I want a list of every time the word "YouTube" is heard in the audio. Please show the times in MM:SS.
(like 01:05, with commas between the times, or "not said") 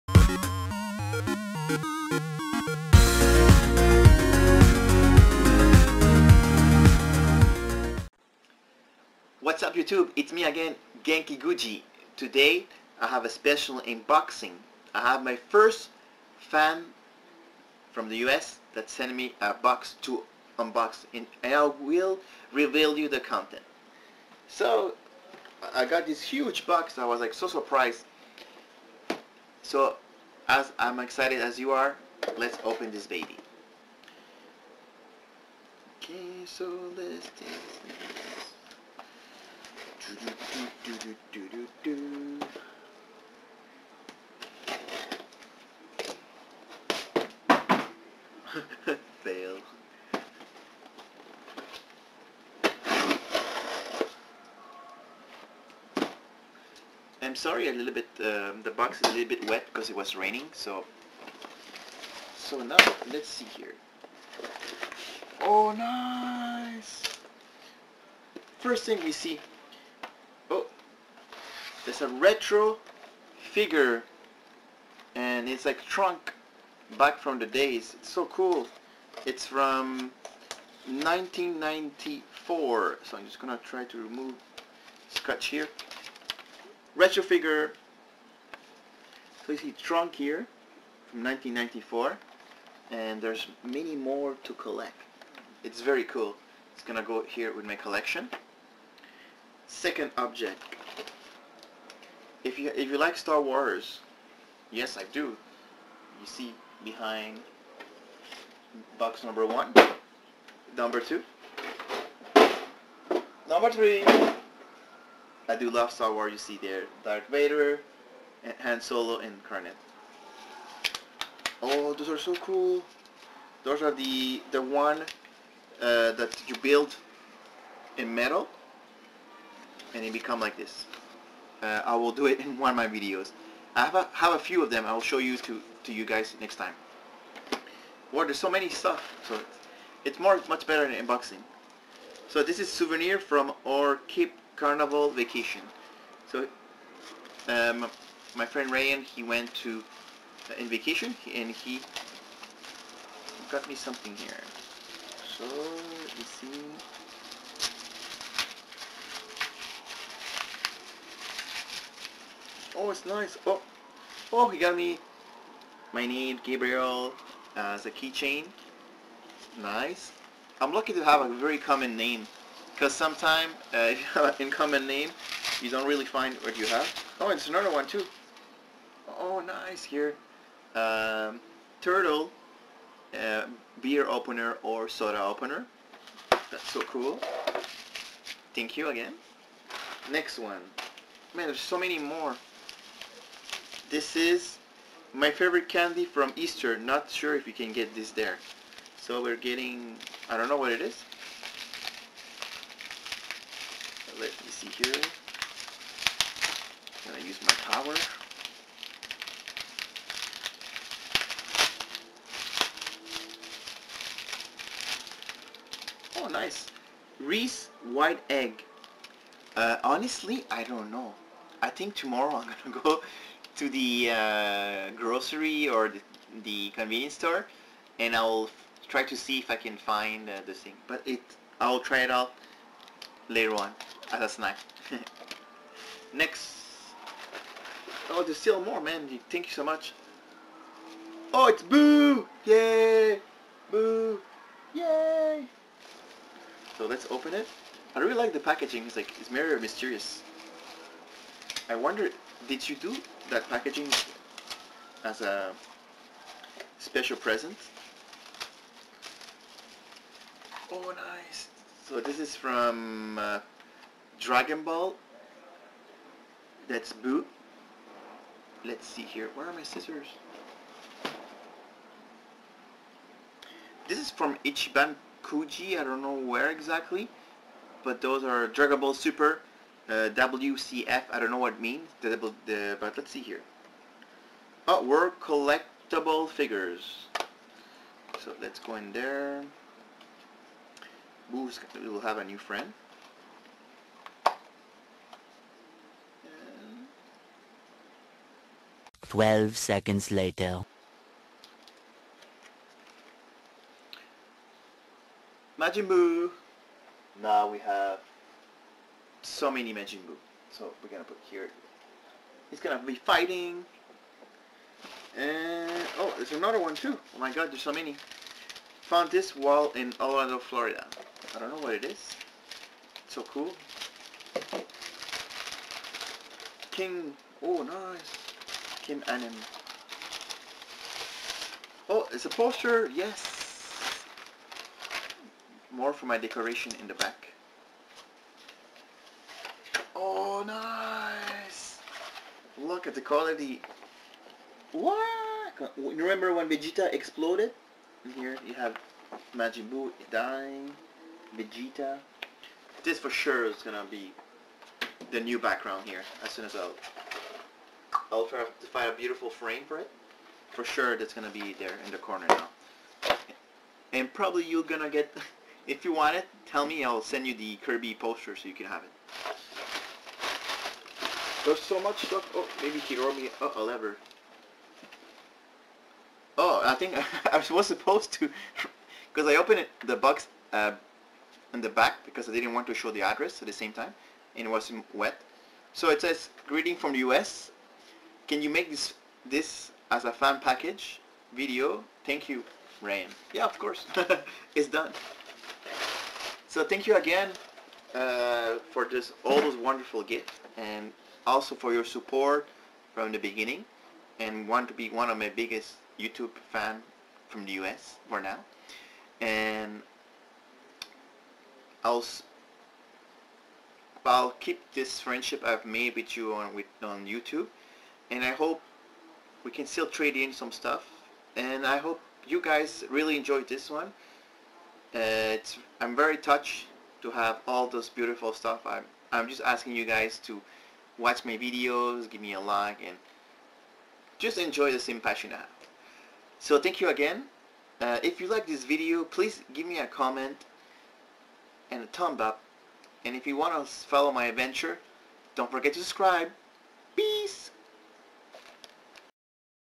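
00:09, 06:45, 06:57.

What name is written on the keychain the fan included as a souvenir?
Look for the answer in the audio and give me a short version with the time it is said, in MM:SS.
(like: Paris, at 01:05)
Gabriel, at 02:46.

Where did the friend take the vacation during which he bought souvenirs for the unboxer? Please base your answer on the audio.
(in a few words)
Cape Canaveral.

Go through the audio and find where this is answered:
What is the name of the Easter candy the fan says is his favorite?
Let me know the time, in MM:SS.
03:37.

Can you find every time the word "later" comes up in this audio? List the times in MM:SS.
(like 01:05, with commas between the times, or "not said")
03:53, 05:00.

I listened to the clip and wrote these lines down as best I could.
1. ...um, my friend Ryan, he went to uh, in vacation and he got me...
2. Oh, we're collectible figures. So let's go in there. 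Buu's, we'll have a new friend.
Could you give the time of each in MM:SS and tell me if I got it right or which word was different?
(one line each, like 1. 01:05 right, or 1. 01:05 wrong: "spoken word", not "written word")
1. 02:27 right
2. 04:44 right.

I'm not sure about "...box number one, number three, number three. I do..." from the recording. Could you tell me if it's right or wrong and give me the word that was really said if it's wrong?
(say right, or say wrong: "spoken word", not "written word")
wrong: "two", not "three".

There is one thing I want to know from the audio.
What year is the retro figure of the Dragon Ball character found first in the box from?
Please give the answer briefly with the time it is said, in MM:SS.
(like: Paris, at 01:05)
1994, at 01:19.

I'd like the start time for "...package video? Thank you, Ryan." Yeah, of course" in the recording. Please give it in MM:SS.
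06:30.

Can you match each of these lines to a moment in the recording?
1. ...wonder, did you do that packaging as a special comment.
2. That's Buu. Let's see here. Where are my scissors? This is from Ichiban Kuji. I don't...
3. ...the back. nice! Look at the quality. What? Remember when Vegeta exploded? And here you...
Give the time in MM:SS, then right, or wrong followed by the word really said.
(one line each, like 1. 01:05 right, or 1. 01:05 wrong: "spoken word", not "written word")
1. 04:11 wrong: "present", not "comment"
2. 04:26 right
3. 05:36 right.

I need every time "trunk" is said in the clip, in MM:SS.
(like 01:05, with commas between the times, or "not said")
01:15, 01:29.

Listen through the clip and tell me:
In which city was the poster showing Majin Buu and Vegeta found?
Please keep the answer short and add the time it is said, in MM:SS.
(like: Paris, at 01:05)
Orlando, at 05:19.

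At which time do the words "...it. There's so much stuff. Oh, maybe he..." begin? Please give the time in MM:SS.
06:08.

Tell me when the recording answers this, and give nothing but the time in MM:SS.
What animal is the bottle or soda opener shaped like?
03:01.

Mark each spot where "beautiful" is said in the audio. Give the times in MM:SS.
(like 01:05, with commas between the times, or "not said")
05:58, 07:07.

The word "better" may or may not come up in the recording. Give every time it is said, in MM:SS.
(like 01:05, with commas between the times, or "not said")
02:20.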